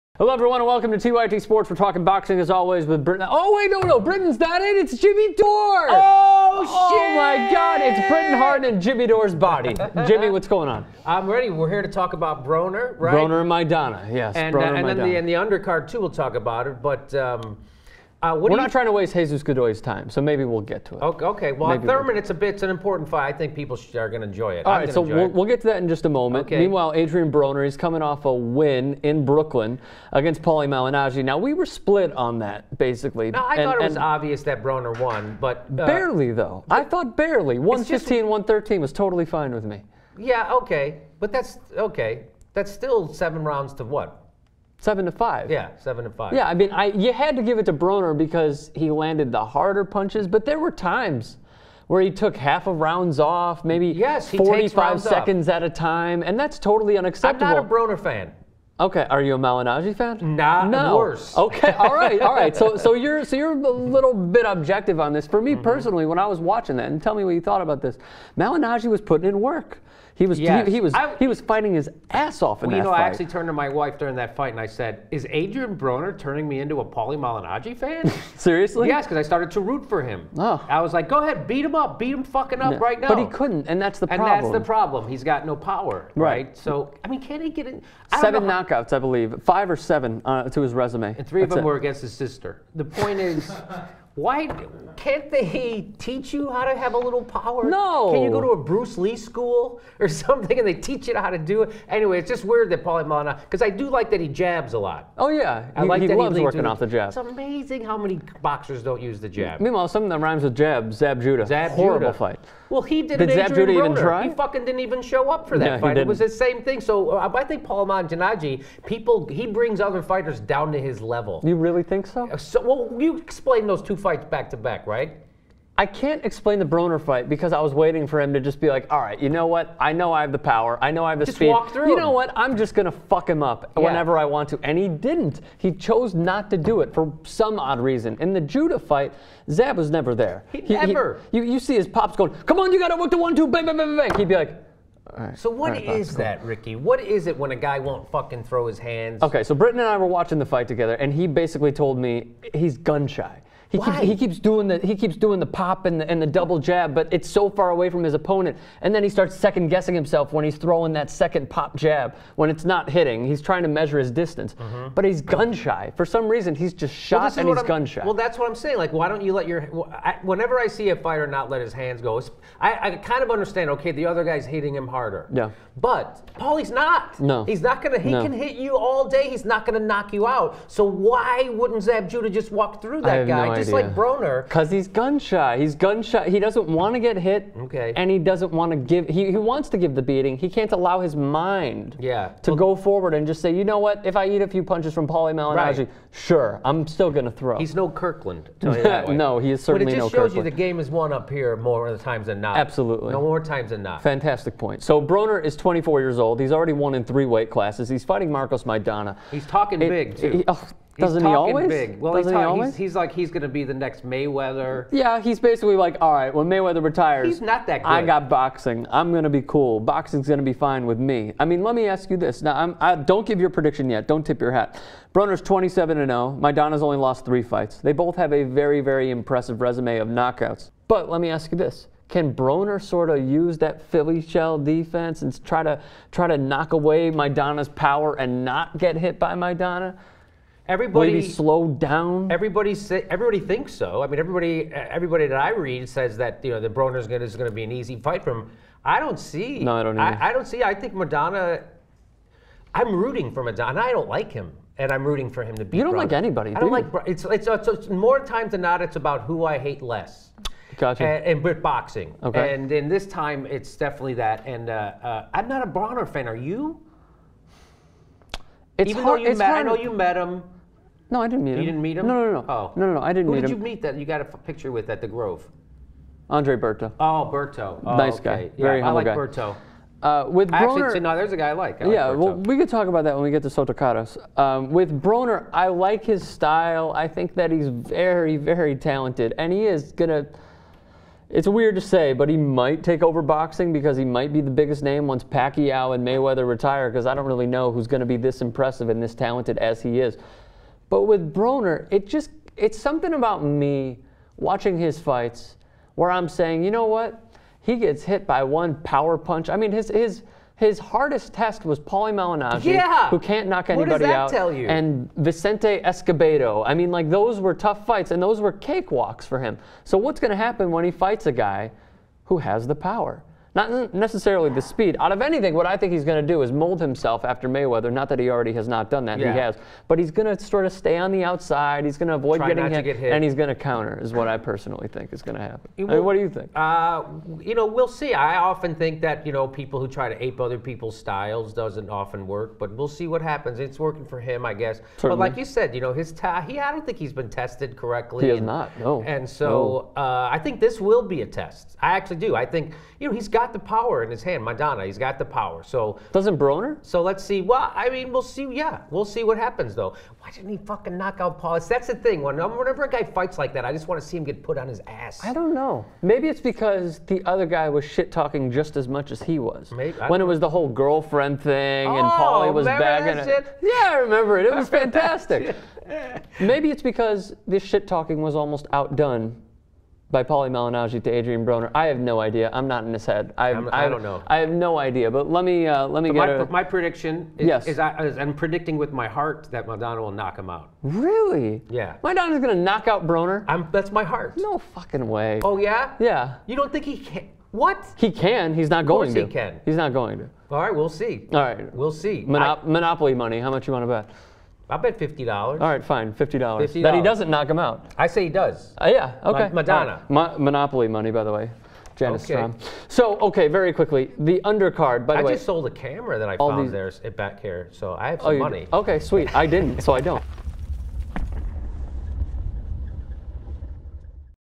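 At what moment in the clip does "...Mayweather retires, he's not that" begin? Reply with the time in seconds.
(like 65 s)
216 s.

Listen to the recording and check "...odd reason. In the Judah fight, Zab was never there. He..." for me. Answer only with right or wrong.
right.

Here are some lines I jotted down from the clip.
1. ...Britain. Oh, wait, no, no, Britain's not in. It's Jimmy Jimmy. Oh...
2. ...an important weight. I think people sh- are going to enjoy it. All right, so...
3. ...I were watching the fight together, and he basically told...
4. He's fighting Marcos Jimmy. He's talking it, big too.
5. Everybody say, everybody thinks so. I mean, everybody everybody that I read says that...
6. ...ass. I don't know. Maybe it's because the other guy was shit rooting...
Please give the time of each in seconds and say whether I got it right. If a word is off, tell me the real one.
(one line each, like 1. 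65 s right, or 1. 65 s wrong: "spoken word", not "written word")
1. 3 s wrong: "Dore", not "Jimmy"
2. 22 s wrong: "fight", not "weight"
3. 149 s right
4. 207 s wrong: "Maidana", not "Jimmy"
5. 242 s right
6. 364 s wrong: "talking", not "rooting".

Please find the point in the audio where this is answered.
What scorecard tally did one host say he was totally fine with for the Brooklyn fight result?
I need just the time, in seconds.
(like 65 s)
37 s.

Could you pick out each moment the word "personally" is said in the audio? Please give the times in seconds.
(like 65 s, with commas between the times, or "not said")
65 s, 334 s.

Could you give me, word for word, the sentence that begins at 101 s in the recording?
Anyway, it's just weird that Paulie Malignaggi, because I do like that he jabs a lot.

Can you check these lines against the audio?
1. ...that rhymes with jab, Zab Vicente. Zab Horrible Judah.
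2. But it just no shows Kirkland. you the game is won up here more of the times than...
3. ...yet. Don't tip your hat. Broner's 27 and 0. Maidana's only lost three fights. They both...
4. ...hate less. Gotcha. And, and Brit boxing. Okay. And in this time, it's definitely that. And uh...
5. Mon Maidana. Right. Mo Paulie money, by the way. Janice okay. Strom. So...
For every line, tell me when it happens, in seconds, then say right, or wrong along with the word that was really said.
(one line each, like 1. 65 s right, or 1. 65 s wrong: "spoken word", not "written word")
1. 110 s wrong: "Judah", not "Vicente"
2. 199 s right
3. 223 s right
4. 259 s right
5. 409 s wrong: "Monopoly", not "Paulie".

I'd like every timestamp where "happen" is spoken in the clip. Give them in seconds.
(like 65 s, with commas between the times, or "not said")
320 s, 335 s, 343 s, 359 s.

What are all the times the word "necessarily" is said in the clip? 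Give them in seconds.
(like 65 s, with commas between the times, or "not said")
323 s.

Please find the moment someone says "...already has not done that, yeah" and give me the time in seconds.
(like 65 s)
328 s.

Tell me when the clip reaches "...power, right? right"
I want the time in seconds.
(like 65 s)
85 s.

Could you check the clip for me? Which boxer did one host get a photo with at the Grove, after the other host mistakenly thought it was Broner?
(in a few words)
Andre Berto.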